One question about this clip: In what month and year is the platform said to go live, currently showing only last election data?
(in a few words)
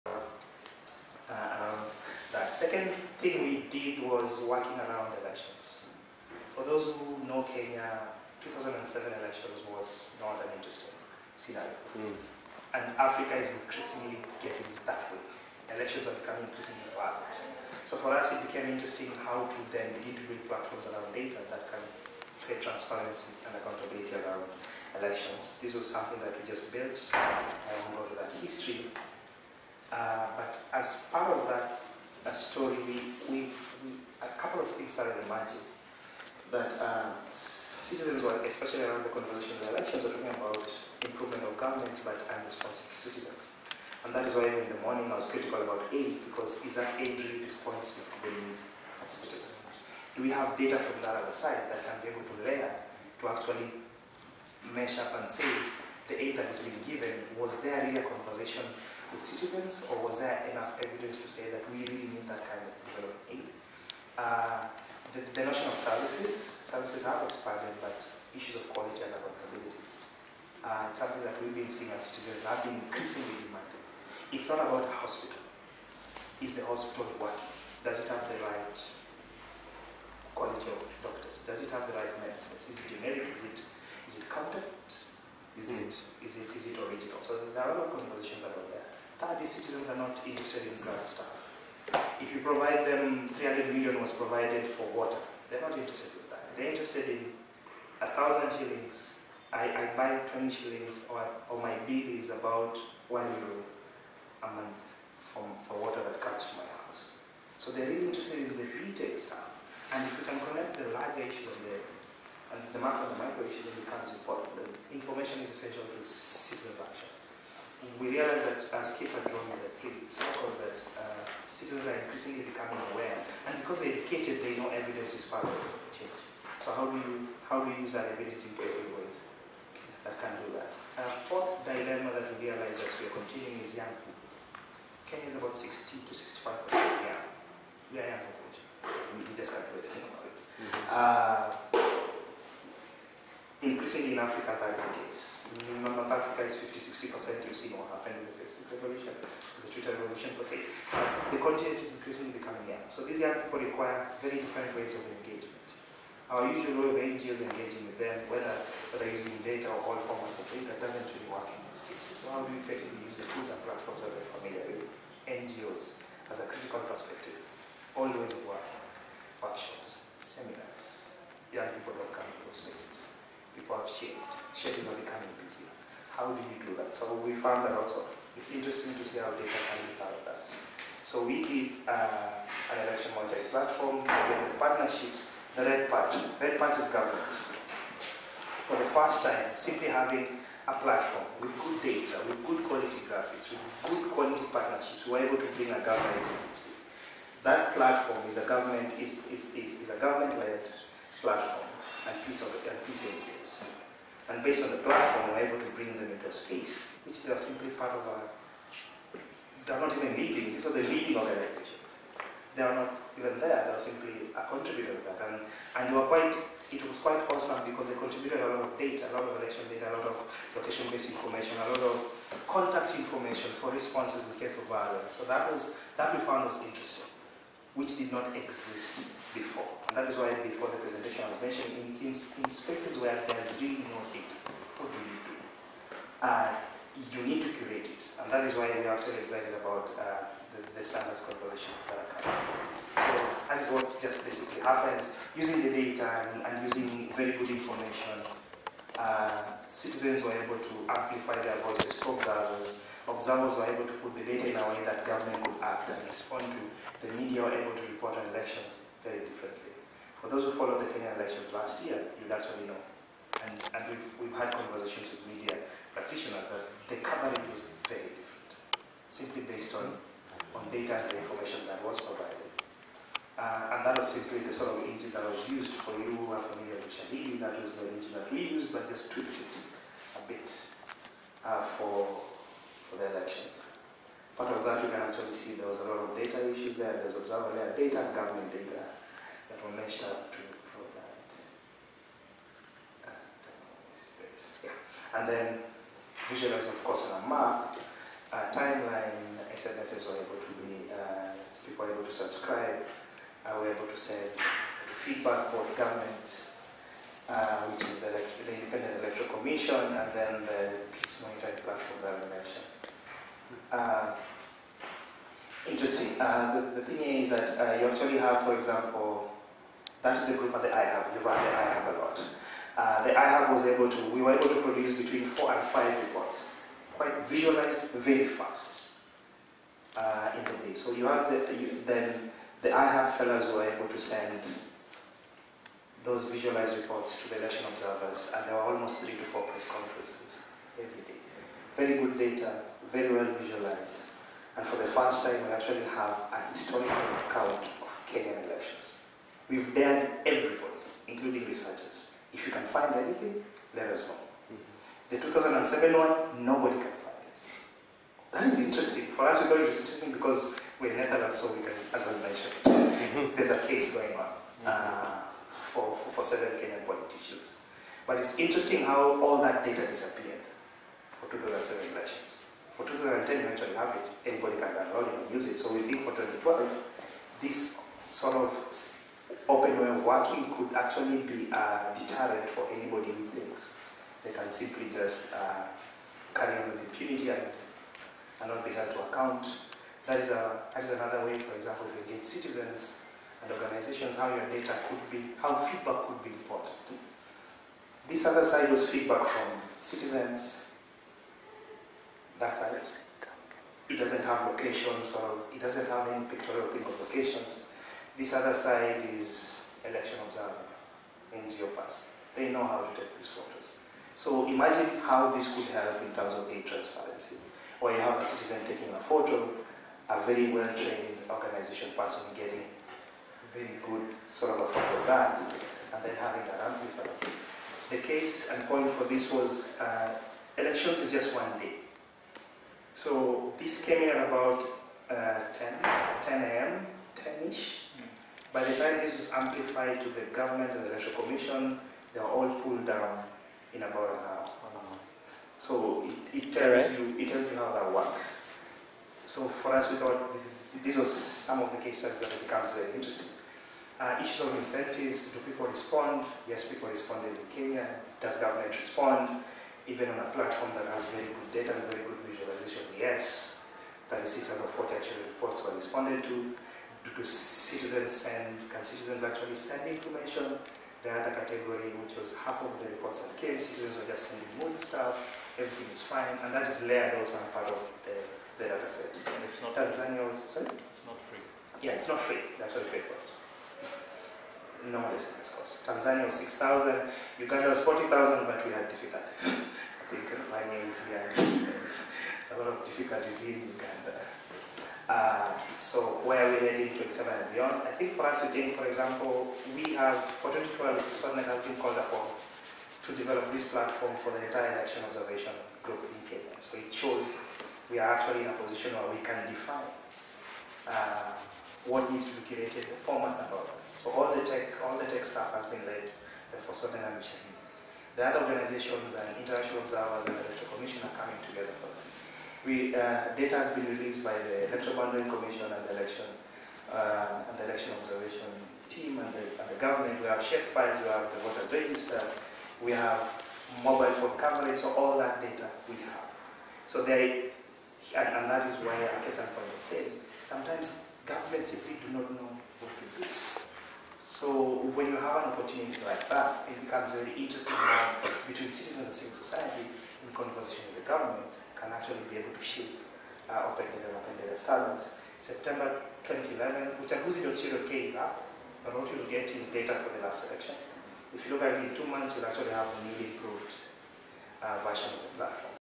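September 2011.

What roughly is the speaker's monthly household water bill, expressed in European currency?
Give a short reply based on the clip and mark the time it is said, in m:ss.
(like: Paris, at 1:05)
one euro, at 1:43.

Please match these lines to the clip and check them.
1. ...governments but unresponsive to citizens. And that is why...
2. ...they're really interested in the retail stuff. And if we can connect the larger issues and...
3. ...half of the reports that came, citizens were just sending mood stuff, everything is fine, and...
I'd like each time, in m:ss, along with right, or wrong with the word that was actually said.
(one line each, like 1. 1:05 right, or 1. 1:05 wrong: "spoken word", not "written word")
1. 0:41 right
2. 1:47 right
3. 7:52 right.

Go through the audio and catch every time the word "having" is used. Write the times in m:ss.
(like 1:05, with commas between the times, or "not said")
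3:09, 7:06.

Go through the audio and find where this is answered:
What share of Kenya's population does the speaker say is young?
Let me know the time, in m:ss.
2:15.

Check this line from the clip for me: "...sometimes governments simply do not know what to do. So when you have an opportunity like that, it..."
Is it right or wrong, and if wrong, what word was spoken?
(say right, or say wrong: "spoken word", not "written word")
right.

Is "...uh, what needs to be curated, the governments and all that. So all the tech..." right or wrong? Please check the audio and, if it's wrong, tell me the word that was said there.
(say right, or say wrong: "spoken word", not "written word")
wrong: "formats", not "governments".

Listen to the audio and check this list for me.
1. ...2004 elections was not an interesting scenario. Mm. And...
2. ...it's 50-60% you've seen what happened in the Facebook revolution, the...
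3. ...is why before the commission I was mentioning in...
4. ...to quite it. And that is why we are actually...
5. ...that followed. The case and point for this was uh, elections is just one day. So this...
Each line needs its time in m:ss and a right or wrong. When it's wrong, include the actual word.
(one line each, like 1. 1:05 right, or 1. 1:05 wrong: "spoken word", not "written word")
1. 0:08 wrong: "2007", not "2004"
2. 2:26 right
3. 3:50 wrong: "presentation", not "commission"
4. 3:57 wrong: "curate", not "quite"
5. 7:06 wrong: "amplified", not "followed".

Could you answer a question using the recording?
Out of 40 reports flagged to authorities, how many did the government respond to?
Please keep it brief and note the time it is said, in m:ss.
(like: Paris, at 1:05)
36, at 7:44.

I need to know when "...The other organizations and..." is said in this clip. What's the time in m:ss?
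8:38.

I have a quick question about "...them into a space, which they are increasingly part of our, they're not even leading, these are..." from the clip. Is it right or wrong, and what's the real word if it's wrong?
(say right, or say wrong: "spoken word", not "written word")
wrong: "simply", not "increasingly".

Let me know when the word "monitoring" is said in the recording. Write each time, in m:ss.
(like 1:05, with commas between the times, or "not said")
3:03, 5:11.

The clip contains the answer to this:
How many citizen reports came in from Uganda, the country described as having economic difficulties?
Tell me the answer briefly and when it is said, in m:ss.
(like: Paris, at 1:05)
40,000, at 8:07.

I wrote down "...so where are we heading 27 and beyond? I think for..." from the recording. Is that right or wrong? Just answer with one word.
right.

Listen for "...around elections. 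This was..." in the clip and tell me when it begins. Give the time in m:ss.
0:24.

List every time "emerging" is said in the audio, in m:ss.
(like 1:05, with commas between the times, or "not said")
0:35.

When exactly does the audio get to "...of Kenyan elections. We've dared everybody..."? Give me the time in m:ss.
5:47.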